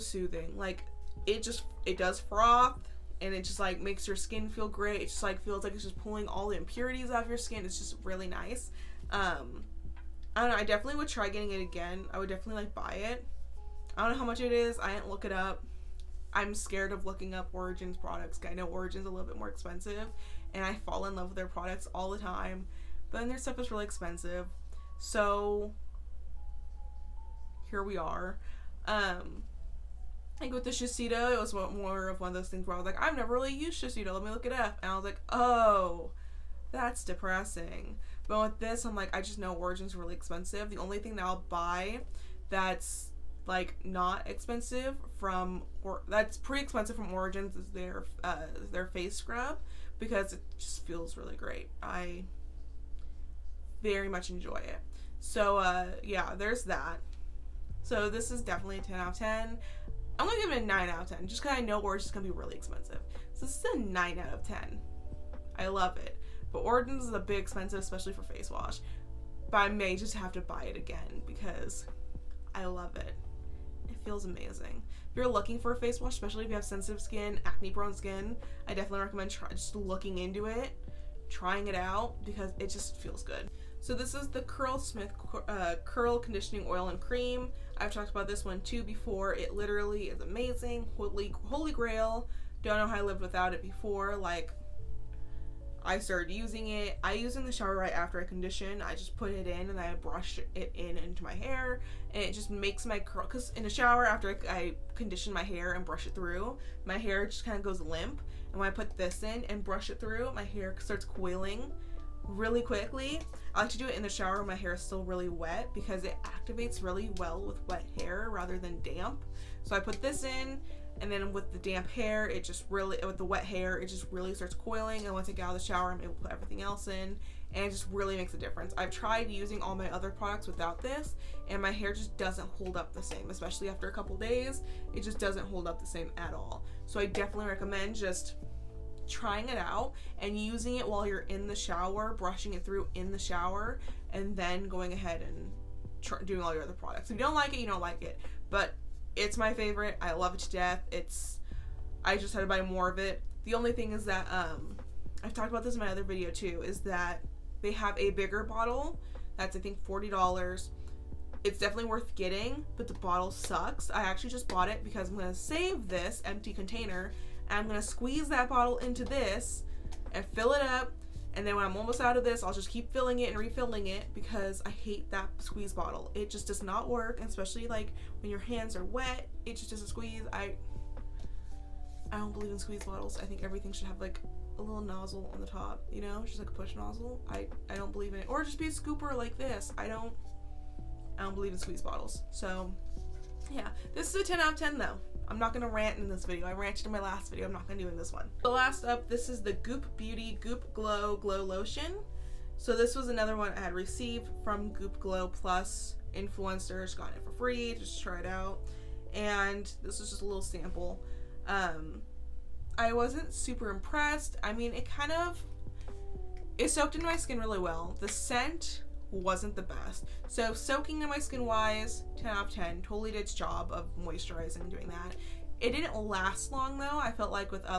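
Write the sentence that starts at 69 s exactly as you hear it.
But I may just have to buy it again because I love it.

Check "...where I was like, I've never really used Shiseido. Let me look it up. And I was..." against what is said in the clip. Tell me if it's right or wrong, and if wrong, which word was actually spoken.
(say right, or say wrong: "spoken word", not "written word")
right.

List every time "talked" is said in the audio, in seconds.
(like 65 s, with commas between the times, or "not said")
87 s, 155 s.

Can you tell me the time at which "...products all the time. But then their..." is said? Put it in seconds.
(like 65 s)
21 s.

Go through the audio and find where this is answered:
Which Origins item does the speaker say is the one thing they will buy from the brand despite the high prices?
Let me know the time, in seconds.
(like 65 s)
48 s.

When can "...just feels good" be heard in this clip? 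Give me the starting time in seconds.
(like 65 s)
82 s.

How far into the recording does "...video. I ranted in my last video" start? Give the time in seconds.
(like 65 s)
196 s.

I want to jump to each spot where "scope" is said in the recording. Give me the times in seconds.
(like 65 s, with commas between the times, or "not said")
not said.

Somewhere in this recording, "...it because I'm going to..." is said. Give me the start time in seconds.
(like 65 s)
164 s.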